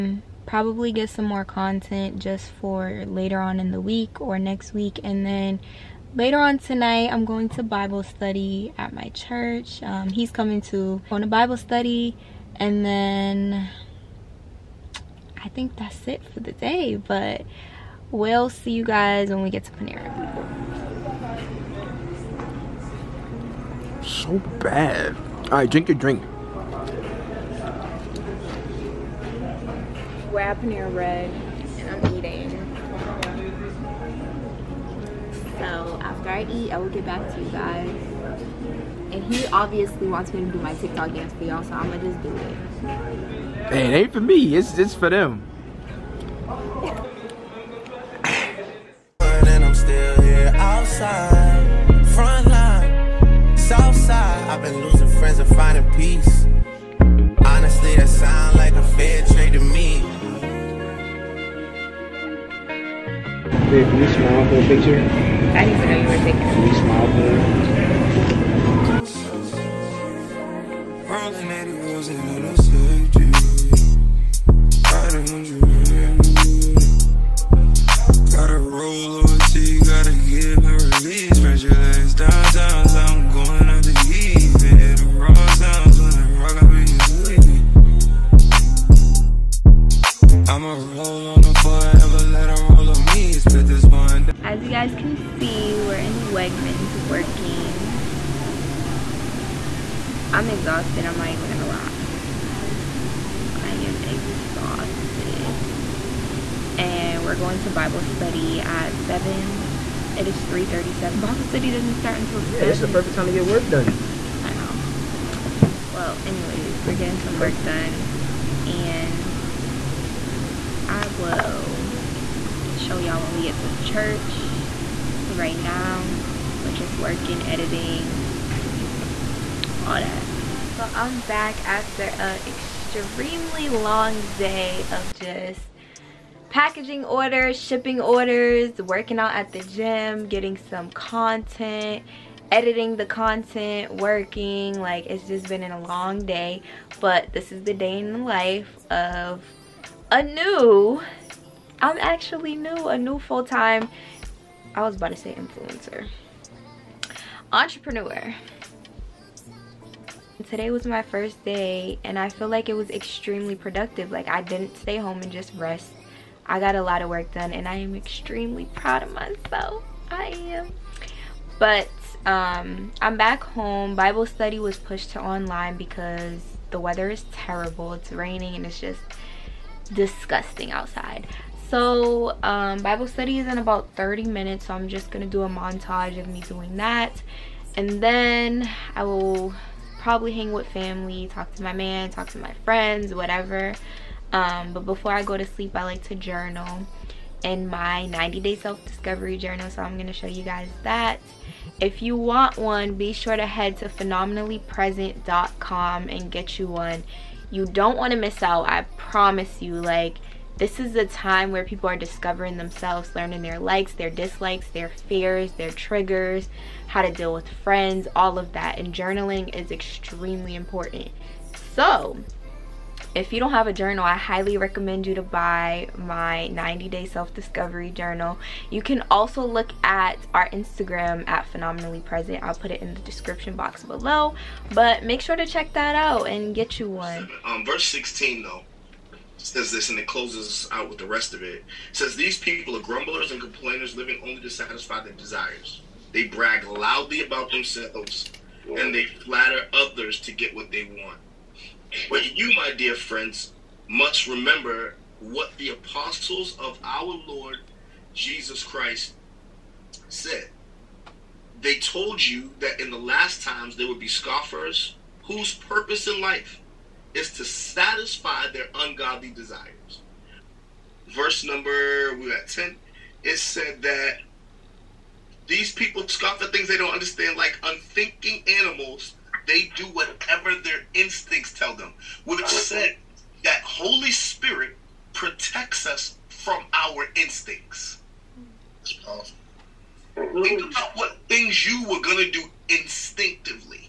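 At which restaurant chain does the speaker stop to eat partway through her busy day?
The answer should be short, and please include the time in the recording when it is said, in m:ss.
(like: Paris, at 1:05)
Panera Bread, at 0:30.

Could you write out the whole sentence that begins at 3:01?
So um, Bible study is in about 30 minutes.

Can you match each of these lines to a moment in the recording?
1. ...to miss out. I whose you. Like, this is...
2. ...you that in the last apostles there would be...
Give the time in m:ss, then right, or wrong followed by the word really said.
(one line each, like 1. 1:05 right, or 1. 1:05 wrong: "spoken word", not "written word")
1. 3:28 wrong: "promise", not "whose"
2. 4:22 wrong: "times", not "apostles".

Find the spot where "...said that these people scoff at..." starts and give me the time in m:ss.
4:33.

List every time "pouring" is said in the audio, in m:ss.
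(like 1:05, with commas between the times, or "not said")
not said.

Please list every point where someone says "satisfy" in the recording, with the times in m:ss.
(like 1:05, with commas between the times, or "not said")
4:04, 4:27.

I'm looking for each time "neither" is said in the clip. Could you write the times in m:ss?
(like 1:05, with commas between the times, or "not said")
not said.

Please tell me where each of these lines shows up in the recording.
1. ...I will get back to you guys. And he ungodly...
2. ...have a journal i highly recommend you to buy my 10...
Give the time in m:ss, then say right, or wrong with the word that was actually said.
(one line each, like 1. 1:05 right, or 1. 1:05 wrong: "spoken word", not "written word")
1. 0:36 wrong: "obviously", not "ungodly"
2. 3:43 wrong: "90", not "10".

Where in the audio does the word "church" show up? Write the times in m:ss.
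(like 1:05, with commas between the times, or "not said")
0:09, 2:03.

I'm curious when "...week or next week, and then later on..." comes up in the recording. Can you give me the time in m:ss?
0:03.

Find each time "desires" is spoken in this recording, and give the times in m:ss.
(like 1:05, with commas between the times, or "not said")
4:05, 4:29.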